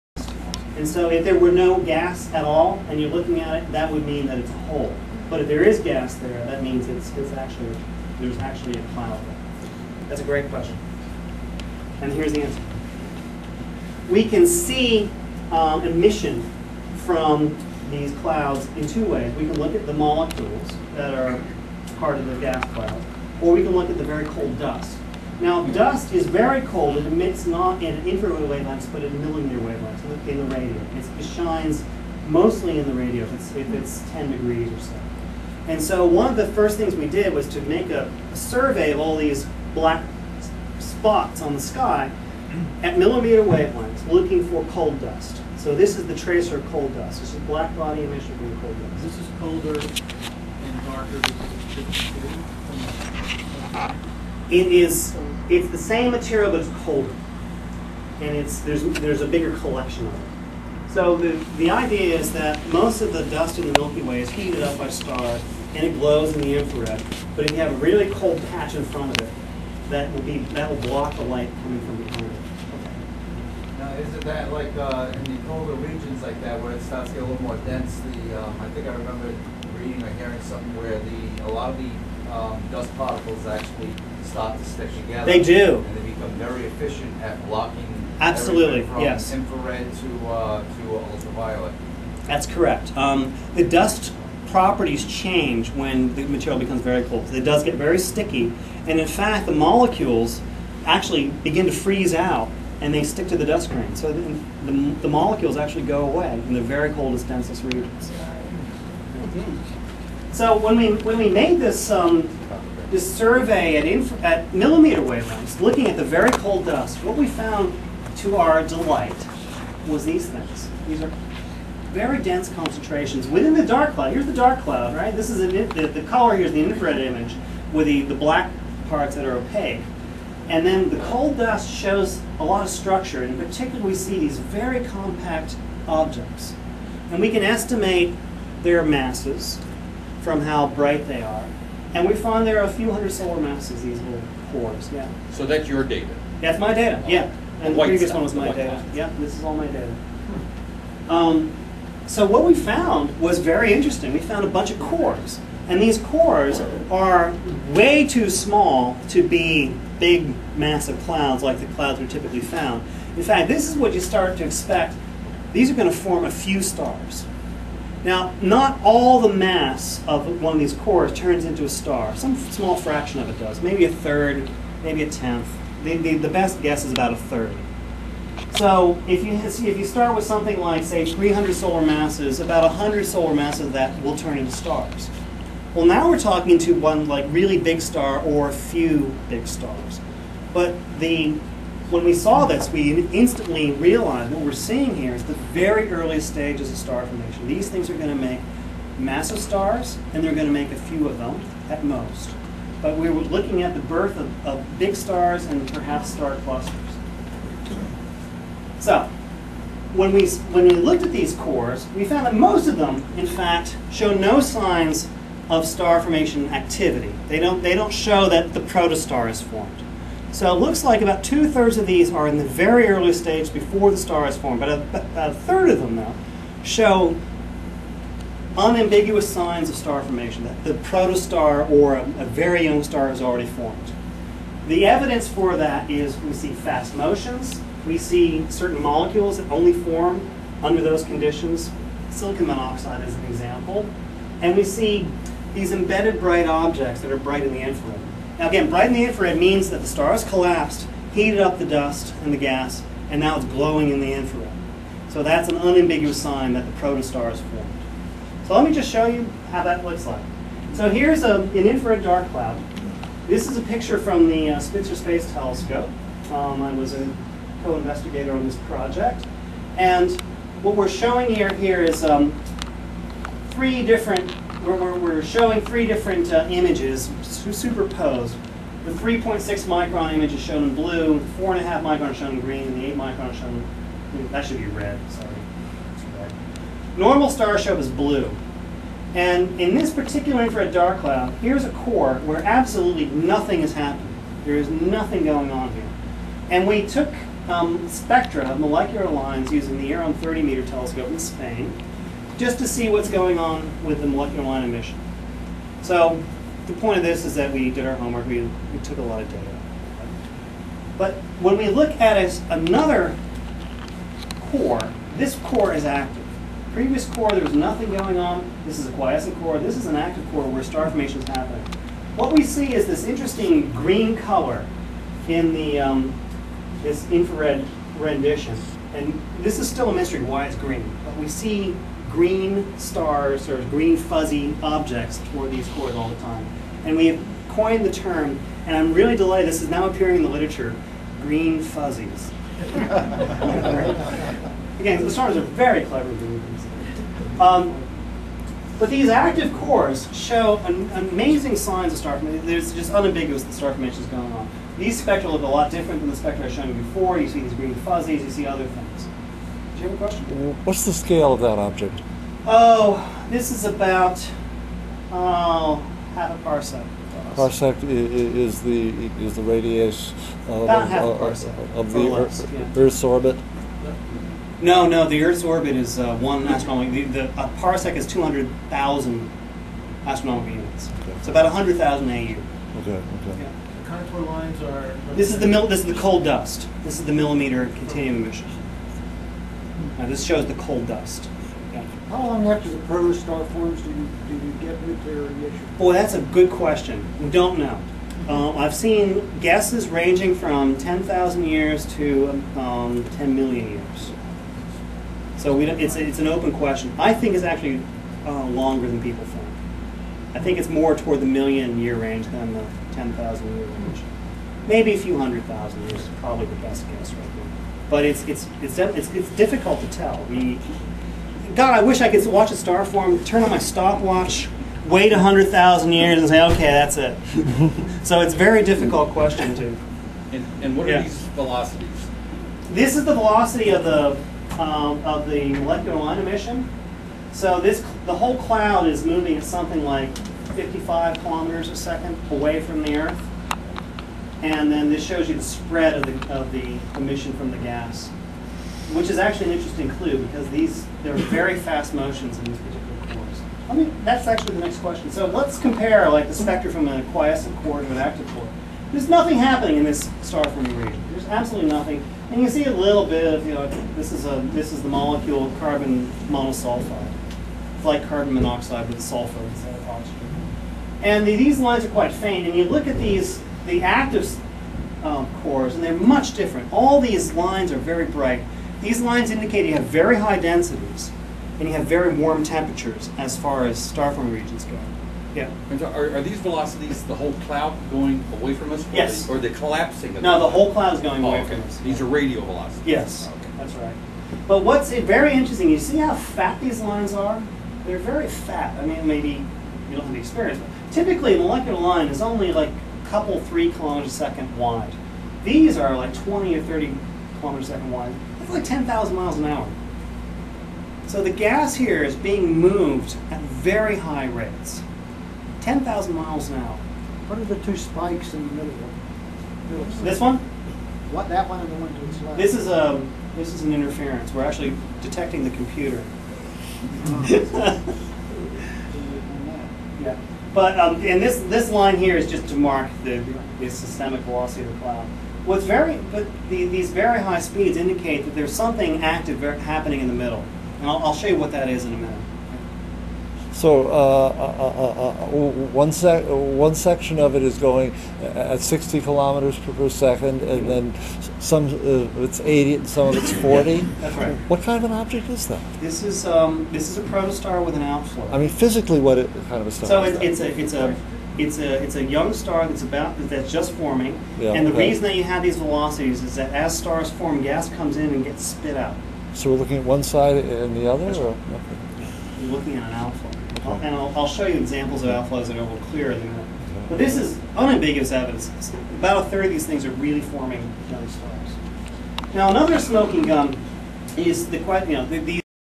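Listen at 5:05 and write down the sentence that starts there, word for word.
So the point of this is that we did our homework, we, we took a lot of data.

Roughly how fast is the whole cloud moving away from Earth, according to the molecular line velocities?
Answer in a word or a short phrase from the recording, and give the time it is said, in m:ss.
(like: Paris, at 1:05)
55 km/s, at 7:20.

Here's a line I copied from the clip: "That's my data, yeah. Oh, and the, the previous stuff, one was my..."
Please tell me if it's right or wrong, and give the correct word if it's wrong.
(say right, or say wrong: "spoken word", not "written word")
right.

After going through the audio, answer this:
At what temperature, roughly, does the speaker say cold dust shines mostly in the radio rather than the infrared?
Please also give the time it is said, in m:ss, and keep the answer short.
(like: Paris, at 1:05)
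10 degrees, at 0:34.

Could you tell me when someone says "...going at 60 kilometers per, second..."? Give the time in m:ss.
9:07.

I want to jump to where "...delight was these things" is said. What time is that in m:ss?
1:58.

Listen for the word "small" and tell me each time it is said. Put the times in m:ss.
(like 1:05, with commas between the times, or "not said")
2:38, 2:52.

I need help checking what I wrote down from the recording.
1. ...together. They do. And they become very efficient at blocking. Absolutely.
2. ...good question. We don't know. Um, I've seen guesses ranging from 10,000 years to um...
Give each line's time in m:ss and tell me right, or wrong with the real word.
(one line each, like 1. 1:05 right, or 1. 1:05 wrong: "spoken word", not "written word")
1. 1:25 right
2. 6:36 right.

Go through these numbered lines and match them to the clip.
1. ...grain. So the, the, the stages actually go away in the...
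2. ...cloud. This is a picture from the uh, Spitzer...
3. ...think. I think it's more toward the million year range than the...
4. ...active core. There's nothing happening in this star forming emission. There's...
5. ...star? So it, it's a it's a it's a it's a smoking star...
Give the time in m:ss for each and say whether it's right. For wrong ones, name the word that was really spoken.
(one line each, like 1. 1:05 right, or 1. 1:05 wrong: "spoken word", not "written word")
1. 1:43 wrong: "molecules", not "stages"
2. 4:22 right
3. 6:49 right
4. 7:37 wrong: "region", not "emission"
5. 9:19 wrong: "young", not "smoking".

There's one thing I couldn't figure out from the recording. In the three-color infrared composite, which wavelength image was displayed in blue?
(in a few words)
3.6 micron.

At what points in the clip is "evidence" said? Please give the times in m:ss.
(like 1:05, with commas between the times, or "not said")
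3:54, 9:38.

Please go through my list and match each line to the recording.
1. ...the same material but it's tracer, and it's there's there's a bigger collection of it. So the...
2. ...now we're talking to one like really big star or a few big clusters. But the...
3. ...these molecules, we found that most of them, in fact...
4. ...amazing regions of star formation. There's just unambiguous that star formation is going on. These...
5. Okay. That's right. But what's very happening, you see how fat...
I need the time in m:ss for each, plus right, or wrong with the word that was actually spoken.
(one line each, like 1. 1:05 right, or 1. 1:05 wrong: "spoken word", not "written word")
1. 0:55 wrong: "colder", not "tracer"
2. 3:05 wrong: "stars", not "clusters"
3. 3:31 wrong: "cores", not "molecules"
4. 5:50 wrong: "signs", not "regions"
5. 8:13 wrong: "interesting", not "happening".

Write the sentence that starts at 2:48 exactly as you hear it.
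Now, not all the mass of one of these cores turns into a star.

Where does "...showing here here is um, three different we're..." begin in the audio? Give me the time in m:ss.
4:30.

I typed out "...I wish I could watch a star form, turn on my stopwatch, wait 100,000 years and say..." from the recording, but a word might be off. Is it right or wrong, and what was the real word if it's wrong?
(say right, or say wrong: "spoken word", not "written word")
right.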